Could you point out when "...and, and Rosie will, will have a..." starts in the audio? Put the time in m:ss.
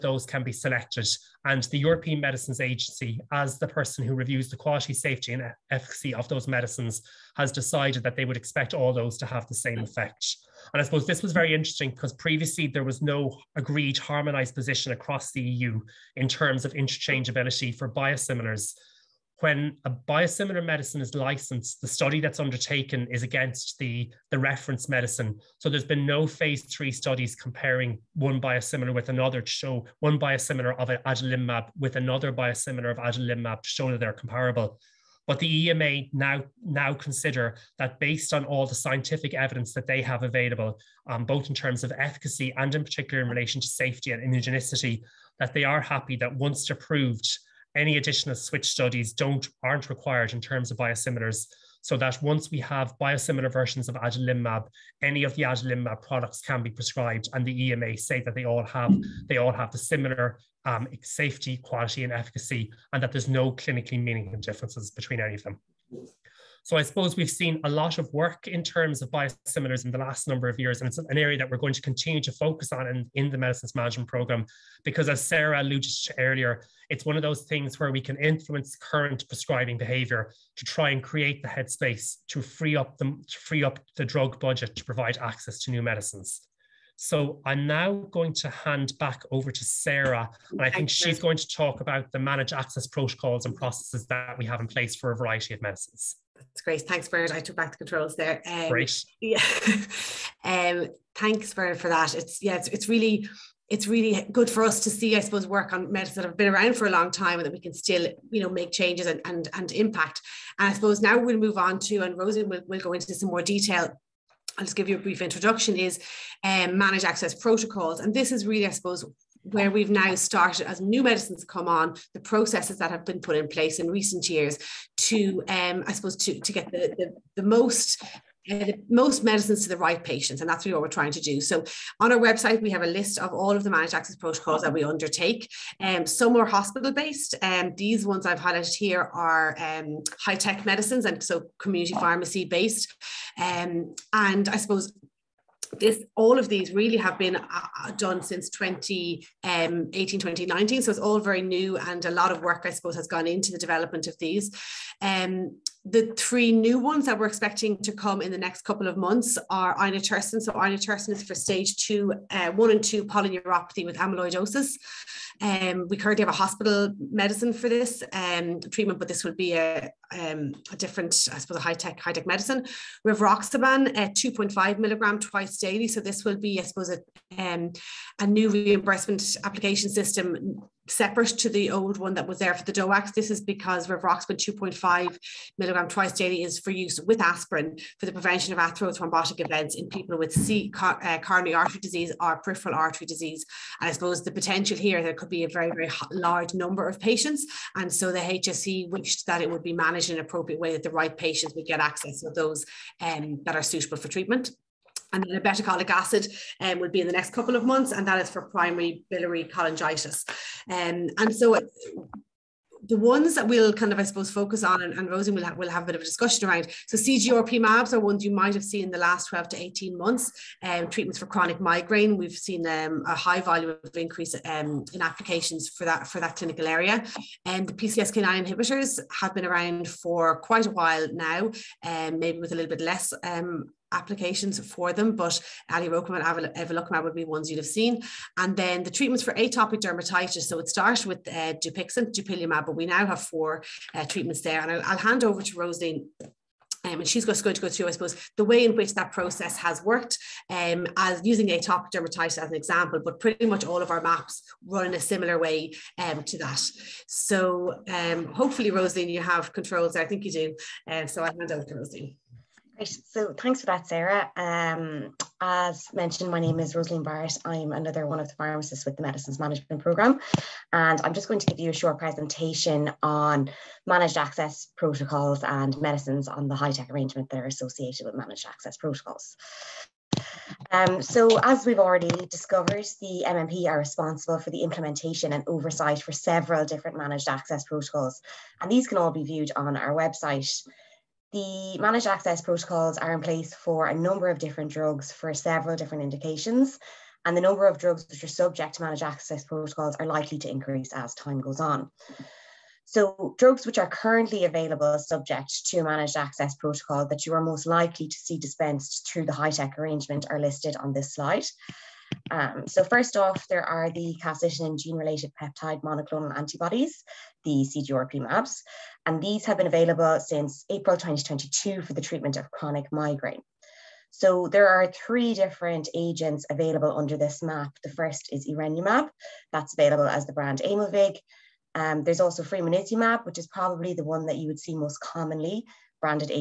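3:34.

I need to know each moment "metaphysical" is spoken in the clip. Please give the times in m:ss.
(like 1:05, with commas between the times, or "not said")
not said.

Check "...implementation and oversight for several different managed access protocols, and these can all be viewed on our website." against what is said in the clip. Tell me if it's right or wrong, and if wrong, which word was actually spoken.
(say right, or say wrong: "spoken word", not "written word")
right.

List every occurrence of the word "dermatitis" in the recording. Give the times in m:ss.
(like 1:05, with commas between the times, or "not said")
3:59, 4:11.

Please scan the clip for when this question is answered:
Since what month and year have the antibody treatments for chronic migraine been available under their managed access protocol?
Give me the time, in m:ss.
5:20.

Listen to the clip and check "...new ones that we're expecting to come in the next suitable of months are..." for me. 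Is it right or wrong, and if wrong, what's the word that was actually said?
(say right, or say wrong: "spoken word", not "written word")
wrong: "couple", not "suitable".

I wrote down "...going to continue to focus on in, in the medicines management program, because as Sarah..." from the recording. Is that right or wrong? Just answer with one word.
right.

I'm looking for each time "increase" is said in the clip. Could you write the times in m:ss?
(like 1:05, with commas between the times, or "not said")
3:43, 5:00.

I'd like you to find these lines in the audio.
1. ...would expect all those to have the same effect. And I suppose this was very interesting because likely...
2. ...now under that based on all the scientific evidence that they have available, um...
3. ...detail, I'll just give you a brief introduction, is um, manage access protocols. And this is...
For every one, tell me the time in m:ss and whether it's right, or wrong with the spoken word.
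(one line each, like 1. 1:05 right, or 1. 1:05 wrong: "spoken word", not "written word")
1. 0:08 wrong: "previously", not "likely"
2. 0:36 wrong: "consider", not "under"
3. 1:53 right.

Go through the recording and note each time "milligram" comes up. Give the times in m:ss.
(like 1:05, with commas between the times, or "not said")
2:54, 3:05.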